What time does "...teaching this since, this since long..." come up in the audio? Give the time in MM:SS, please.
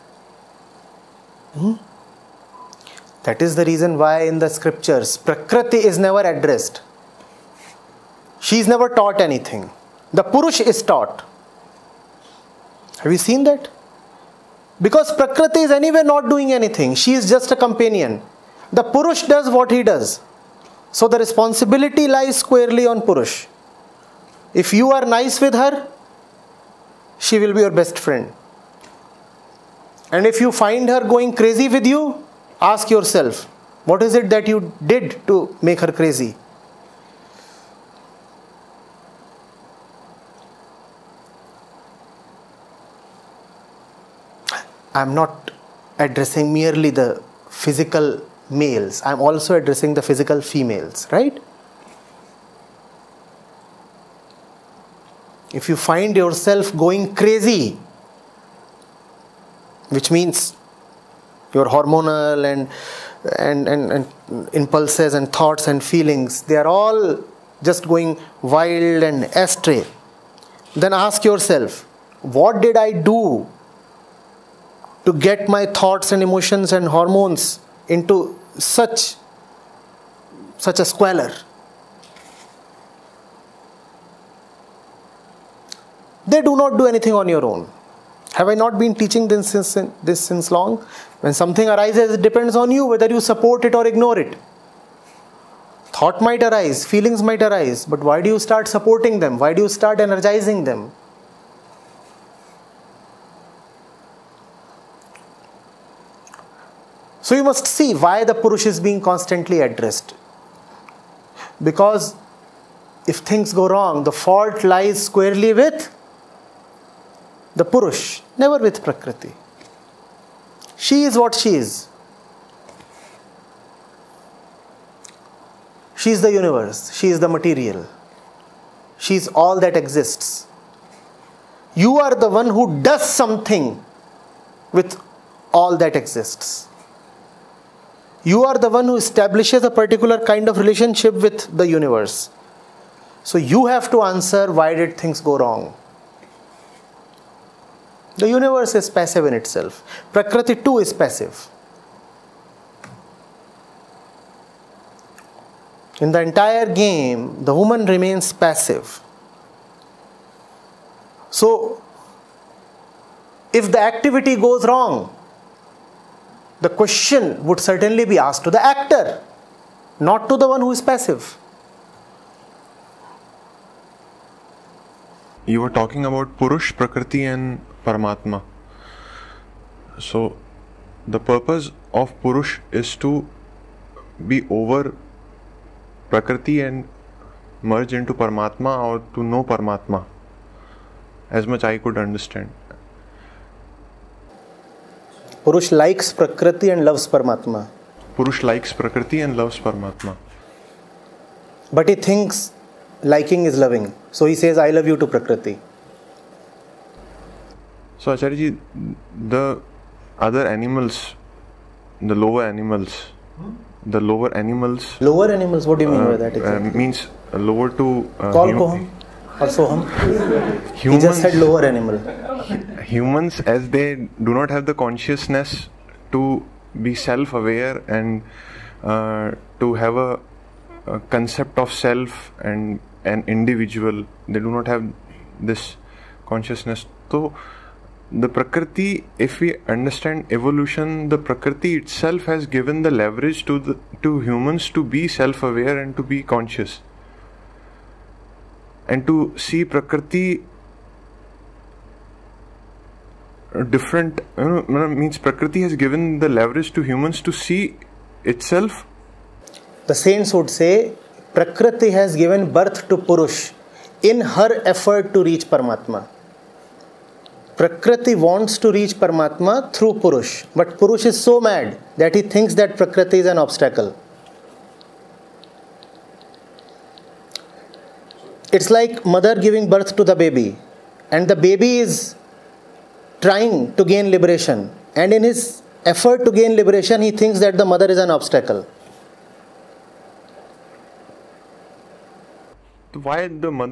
01:29.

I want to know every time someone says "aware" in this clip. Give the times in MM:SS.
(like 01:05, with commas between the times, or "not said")
03:47, 04:05.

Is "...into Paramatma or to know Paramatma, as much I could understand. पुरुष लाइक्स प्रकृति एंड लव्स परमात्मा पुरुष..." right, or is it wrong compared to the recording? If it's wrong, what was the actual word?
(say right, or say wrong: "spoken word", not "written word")
right.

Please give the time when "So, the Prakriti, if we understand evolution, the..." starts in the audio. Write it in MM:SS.
03:57.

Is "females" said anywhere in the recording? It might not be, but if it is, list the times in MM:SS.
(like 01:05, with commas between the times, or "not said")
00:50.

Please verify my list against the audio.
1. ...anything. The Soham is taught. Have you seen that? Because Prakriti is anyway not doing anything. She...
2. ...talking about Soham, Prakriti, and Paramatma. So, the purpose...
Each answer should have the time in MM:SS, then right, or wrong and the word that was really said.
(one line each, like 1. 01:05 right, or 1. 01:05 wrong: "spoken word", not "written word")
1. 00:09 wrong: "Purush", not "Soham"
2. 02:55 wrong: "Purush", not "Soham".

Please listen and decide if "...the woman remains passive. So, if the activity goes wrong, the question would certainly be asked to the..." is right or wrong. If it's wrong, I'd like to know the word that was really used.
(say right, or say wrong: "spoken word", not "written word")
right.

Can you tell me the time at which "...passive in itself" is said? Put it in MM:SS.
02:28.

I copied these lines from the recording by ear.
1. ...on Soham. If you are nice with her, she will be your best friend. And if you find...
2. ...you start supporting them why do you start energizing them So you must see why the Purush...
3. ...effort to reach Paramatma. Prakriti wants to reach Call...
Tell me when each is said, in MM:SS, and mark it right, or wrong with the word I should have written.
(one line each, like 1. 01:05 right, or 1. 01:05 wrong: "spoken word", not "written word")
1. 00:22 wrong: "Purush", not "Soham"
2. 01:38 right
3. 04:24 wrong: "Paramatma", not "Call".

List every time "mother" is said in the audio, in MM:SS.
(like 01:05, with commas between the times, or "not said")
04:39, 04:47.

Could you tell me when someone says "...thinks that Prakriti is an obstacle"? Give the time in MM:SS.
04:32.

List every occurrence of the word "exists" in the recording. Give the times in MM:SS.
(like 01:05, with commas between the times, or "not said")
02:09, 02:15.